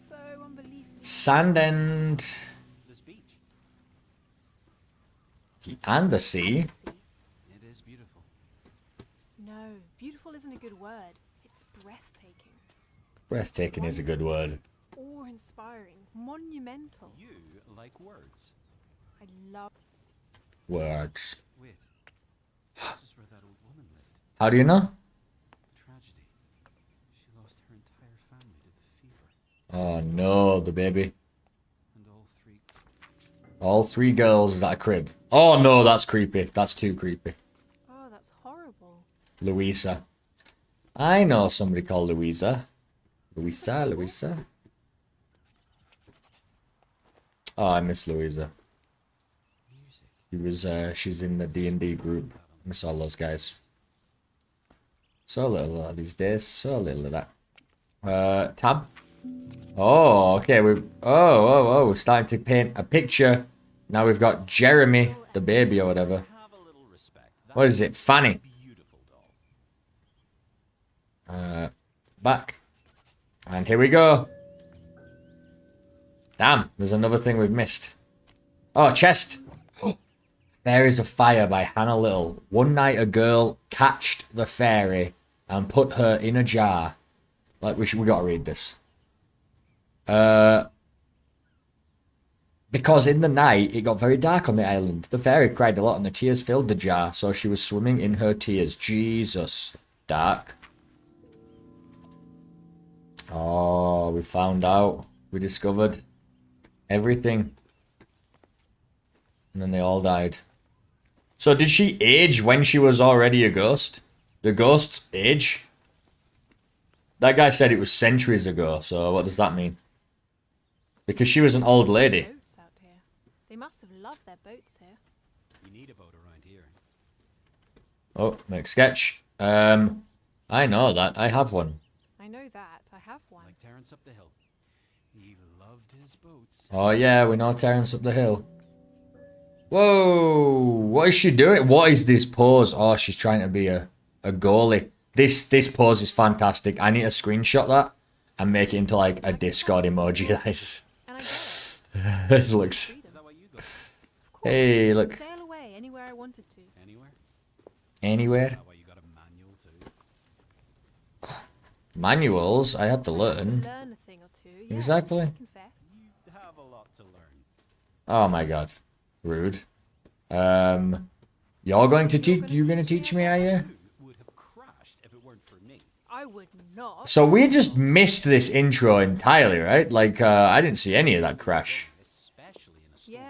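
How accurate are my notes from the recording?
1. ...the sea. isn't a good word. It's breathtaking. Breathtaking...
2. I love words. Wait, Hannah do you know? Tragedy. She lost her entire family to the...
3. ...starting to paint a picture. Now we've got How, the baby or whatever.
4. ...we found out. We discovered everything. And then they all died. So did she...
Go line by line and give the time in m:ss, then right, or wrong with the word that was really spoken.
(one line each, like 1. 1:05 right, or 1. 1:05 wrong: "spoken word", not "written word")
1. 0:06 right
2. 0:19 wrong: "How", not "Hannah"
3. 1:01 wrong: "Jeremy", not "How"
4. 1:44 right.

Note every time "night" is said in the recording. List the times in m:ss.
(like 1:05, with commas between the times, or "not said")
1:22, 1:33.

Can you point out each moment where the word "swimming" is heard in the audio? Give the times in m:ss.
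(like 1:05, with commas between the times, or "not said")
1:37.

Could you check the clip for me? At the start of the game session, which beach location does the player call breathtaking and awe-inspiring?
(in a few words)
Sandend.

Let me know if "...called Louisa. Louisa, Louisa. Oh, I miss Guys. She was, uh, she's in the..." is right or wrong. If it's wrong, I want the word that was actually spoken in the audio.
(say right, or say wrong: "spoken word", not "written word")
wrong: "Louisa", not "Guys".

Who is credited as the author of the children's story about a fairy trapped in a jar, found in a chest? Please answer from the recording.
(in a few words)
Hannah Little.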